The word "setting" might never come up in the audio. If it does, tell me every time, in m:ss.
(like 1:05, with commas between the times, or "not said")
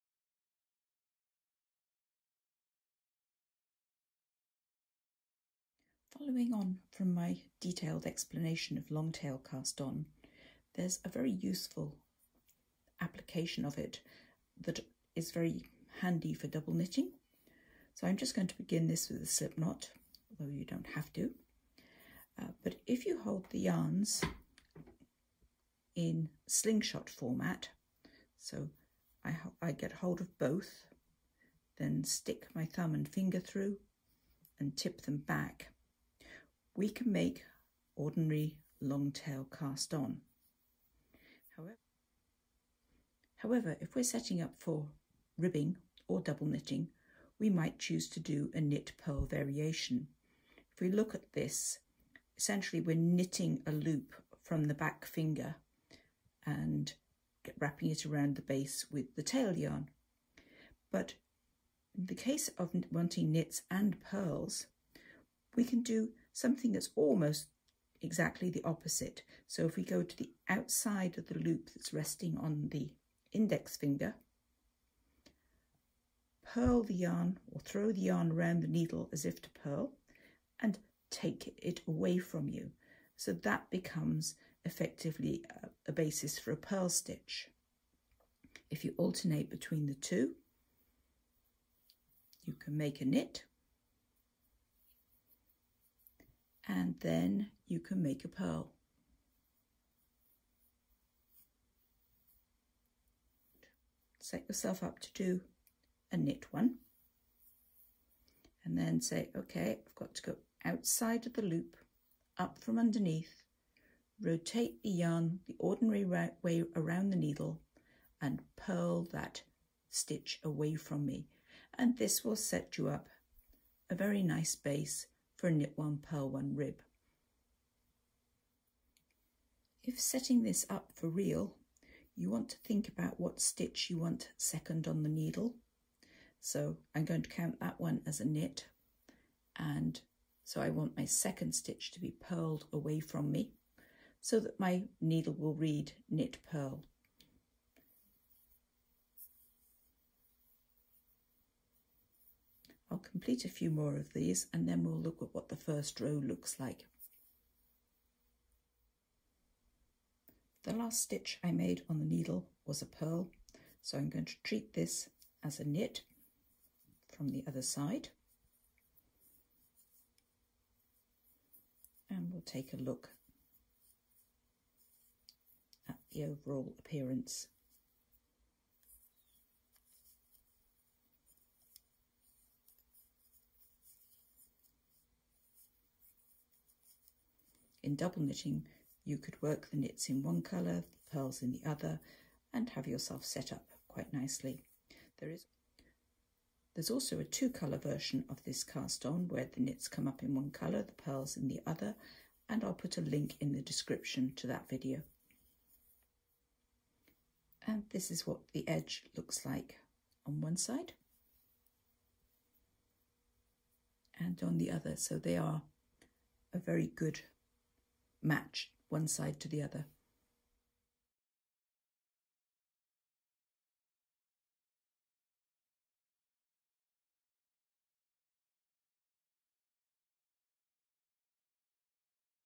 0:44, 2:09.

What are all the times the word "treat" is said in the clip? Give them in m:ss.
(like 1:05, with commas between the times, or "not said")
2:44.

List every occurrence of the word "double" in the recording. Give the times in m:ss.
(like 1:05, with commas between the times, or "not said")
0:16, 0:46, 3:07.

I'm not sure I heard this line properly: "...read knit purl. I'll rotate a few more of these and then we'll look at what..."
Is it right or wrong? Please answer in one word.
wrong.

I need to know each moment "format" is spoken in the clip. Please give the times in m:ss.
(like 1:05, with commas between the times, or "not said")
0:27.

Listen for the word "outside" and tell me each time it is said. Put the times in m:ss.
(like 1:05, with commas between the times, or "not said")
1:10, 1:50.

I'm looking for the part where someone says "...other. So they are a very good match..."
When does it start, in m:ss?
3:34.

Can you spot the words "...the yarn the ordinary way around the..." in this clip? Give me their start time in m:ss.
1:54.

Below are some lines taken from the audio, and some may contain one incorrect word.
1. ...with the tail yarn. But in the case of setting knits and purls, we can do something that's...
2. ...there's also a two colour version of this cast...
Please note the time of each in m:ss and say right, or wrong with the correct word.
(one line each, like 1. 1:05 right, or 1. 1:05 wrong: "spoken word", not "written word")
1. 0:58 wrong: "wanting", not "setting"
2. 3:16 right.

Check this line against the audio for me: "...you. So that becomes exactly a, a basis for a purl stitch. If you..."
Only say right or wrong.
wrong.